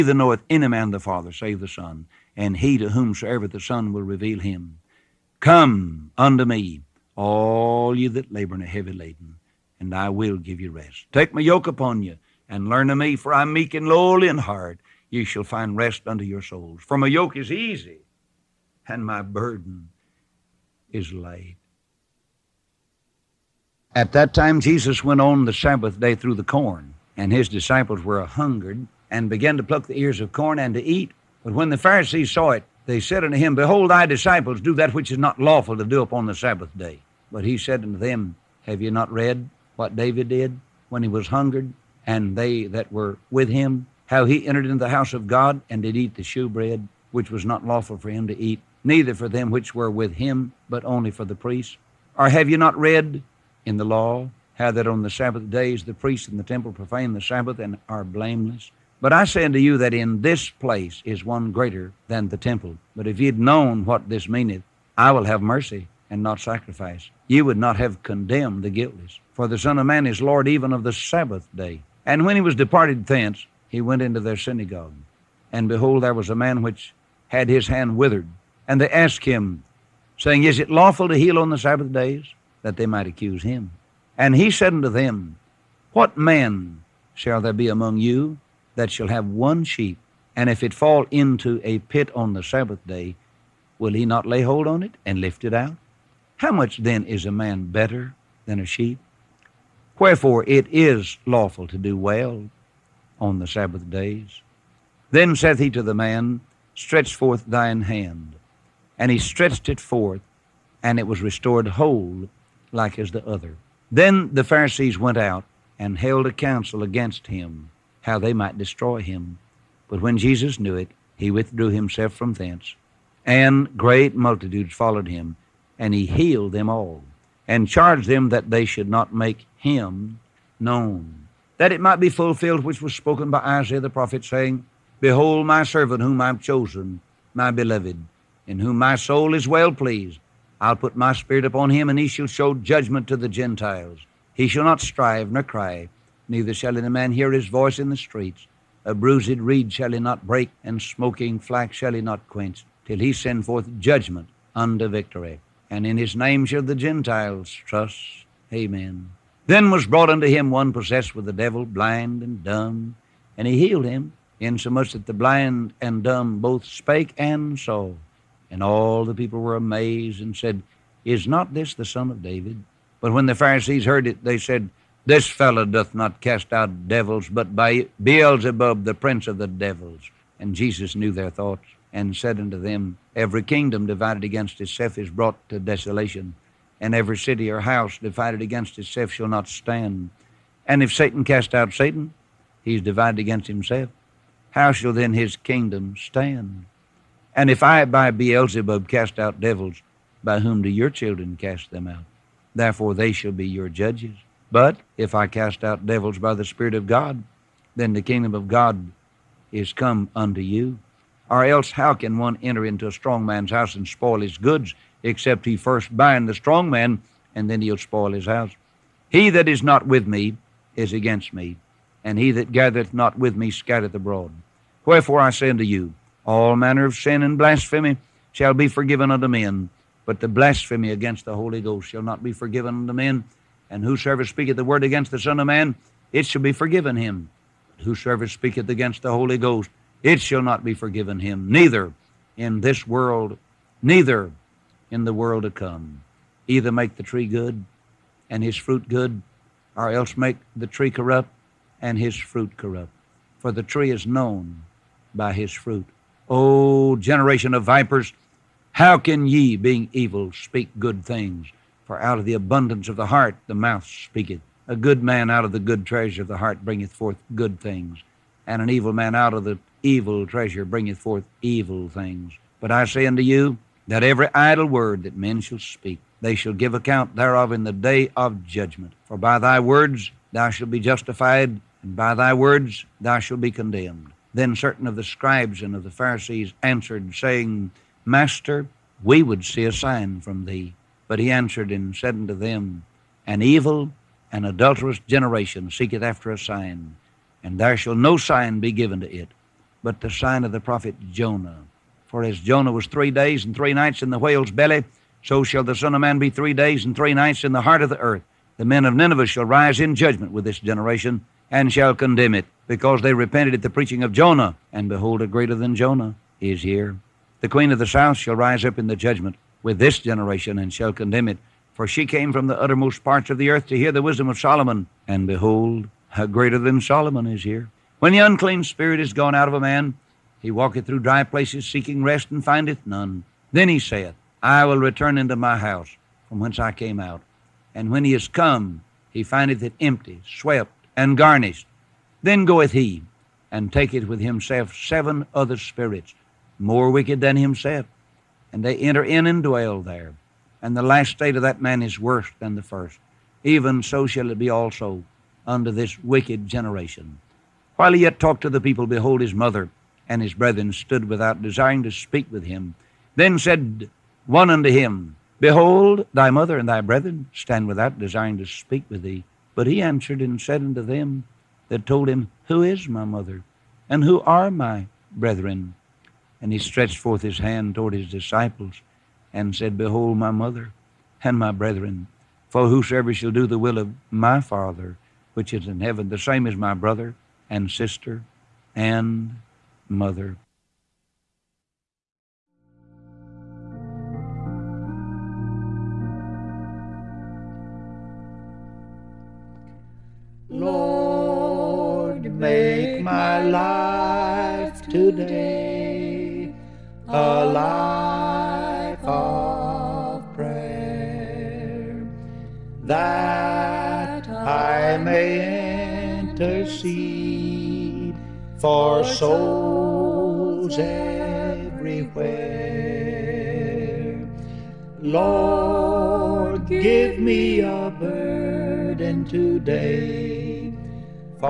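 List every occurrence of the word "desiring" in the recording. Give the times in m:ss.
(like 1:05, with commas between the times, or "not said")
6:01, 6:07.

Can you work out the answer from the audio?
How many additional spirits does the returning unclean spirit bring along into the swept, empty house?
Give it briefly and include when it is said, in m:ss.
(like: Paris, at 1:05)
7, at 5:44.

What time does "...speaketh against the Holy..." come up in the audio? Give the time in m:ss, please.
3:58.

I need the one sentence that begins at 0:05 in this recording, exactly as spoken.
Come unto me, all ye that labor and are heavy laden, and I will give you rest.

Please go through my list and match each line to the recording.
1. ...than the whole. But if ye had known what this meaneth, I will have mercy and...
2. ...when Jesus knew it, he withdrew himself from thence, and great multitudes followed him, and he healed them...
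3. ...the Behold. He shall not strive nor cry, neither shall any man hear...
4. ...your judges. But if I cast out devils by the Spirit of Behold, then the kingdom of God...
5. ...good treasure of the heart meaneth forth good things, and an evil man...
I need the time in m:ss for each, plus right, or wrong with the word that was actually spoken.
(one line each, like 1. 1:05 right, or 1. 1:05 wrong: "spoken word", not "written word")
1. 1:02 wrong: "temple", not "whole"
2. 2:00 right
3. 2:23 wrong: "Gentiles", not "Behold"
4. 3:23 wrong: "God", not "Behold"
5. 4:25 wrong: "bringeth", not "meaneth".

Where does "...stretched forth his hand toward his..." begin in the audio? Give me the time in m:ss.
6:16.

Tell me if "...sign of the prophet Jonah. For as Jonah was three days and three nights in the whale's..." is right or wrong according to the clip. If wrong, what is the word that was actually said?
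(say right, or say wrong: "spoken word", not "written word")
right.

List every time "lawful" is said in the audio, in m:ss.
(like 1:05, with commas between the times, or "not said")
0:35, 0:47, 1:20, 1:41.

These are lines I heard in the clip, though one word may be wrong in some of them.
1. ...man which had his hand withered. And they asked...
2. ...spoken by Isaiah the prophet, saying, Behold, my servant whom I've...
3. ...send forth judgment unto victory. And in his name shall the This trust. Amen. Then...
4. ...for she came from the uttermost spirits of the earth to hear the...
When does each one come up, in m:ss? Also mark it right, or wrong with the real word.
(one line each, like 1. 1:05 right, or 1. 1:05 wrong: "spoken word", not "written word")
1. 1:16 right
2. 2:12 right
3. 2:33 wrong: "Gentiles", not "This"
4. 5:21 wrong: "parts", not "spirits".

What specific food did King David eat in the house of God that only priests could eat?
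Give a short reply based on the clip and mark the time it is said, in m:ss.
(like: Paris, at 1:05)
Shewbread, at 0:46.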